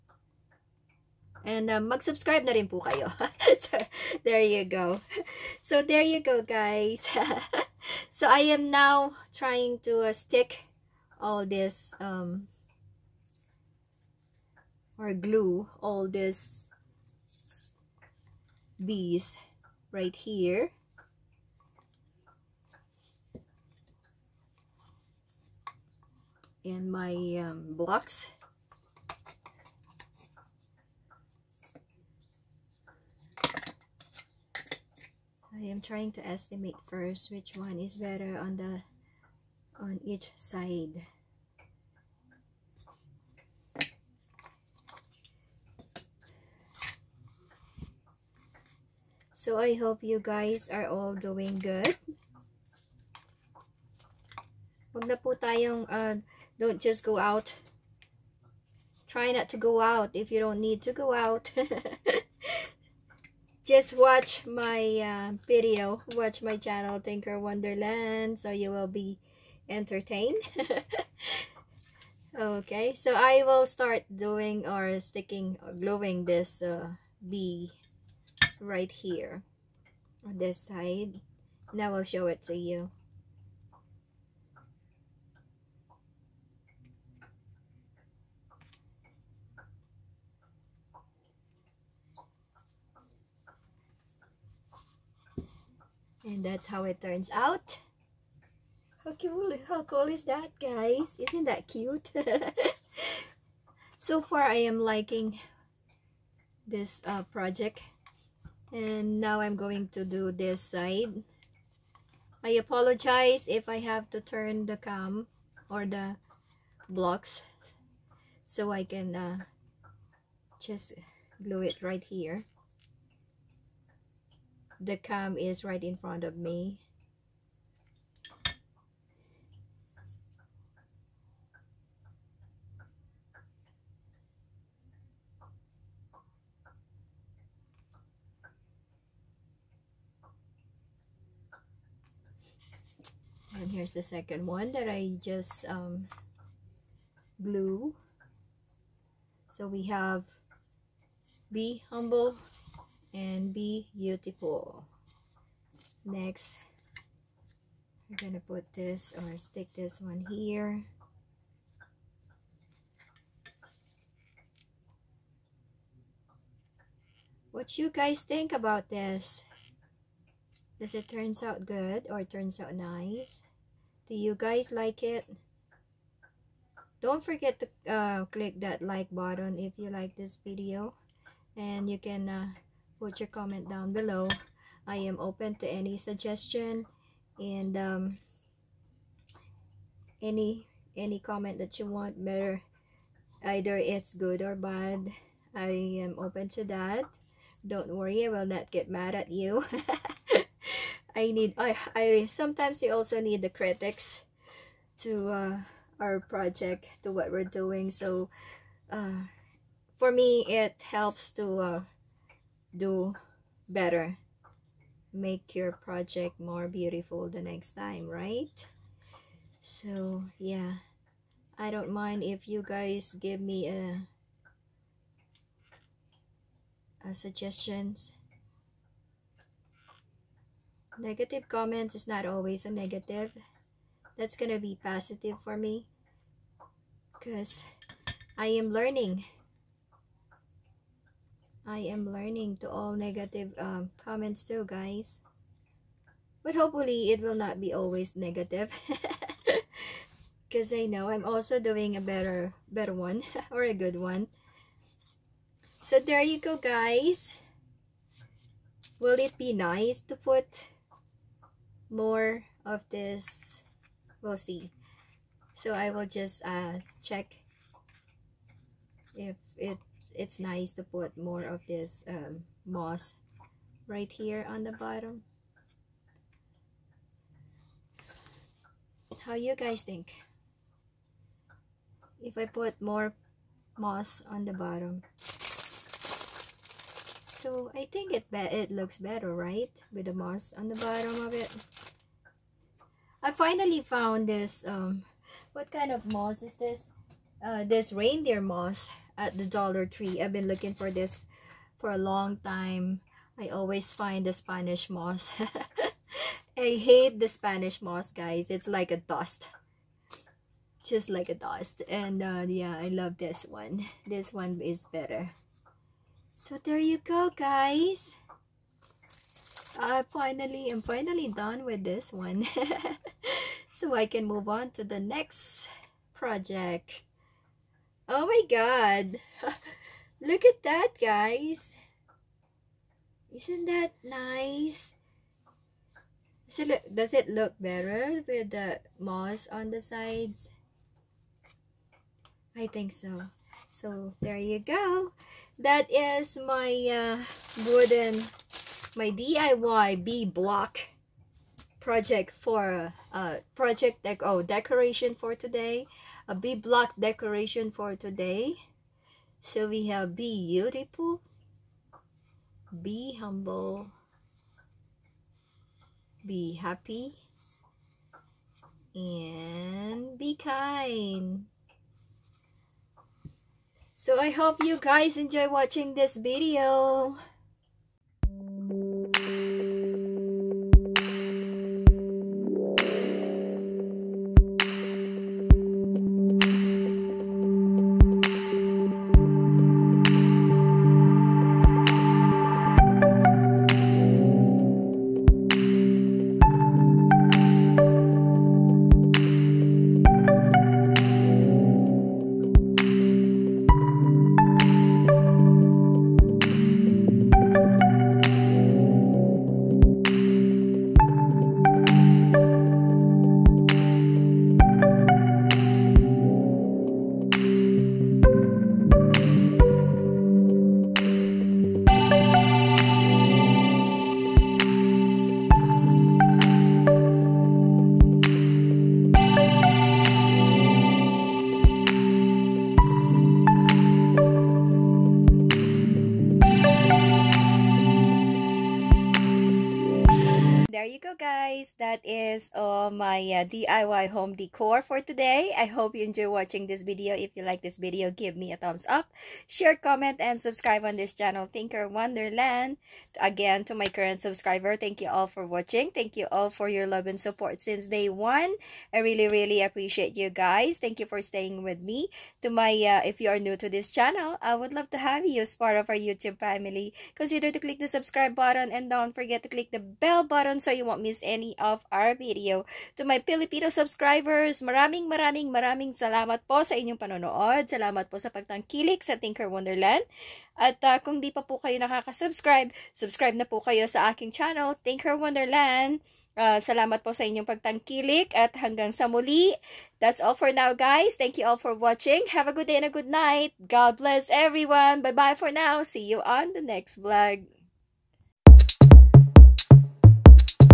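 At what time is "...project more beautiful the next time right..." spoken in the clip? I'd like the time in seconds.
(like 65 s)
215 s.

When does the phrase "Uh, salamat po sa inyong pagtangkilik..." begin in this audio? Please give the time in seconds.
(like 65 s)
486 s.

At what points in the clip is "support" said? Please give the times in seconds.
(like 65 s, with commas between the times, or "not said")
457 s.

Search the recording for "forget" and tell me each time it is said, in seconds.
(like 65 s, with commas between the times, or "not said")
177 s, 469 s.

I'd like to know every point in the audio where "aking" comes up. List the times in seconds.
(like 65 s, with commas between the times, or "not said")
484 s.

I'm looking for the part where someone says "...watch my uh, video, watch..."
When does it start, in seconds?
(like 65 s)
63 s.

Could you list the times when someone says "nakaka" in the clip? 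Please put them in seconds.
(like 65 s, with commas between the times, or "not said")
481 s.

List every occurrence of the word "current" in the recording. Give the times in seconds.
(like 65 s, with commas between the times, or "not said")
453 s.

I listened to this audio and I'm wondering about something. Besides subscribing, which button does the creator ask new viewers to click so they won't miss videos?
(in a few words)
bell button.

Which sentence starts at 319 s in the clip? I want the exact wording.
I finally am finally done with this one.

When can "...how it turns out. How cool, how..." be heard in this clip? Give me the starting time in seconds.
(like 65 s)
96 s.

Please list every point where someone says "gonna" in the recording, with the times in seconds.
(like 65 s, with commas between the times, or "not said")
158 s, 234 s.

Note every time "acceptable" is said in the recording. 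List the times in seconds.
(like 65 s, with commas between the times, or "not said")
not said.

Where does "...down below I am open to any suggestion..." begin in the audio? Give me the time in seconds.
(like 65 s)
183 s.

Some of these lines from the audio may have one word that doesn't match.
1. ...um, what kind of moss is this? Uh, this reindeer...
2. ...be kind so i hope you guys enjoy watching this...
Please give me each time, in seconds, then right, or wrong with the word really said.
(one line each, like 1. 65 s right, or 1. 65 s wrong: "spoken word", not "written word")
1. 294 s right
2. 370 s right.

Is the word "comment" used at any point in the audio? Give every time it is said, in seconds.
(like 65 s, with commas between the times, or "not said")
183 s, 191 s, 231 s, 244 s, 449 s.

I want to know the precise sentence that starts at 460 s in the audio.
Thank you for staying with me.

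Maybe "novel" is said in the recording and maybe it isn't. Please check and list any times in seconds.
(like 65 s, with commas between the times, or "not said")
not said.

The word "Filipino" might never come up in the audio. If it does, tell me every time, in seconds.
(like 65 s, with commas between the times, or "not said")
473 s.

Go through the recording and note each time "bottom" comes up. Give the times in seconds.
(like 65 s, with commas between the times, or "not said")
274 s, 284 s, 290 s.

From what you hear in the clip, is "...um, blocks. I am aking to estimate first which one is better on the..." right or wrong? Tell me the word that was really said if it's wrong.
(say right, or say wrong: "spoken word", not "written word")
wrong: "trying", not "aking".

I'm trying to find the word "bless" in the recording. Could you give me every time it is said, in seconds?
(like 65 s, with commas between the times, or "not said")
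493 s.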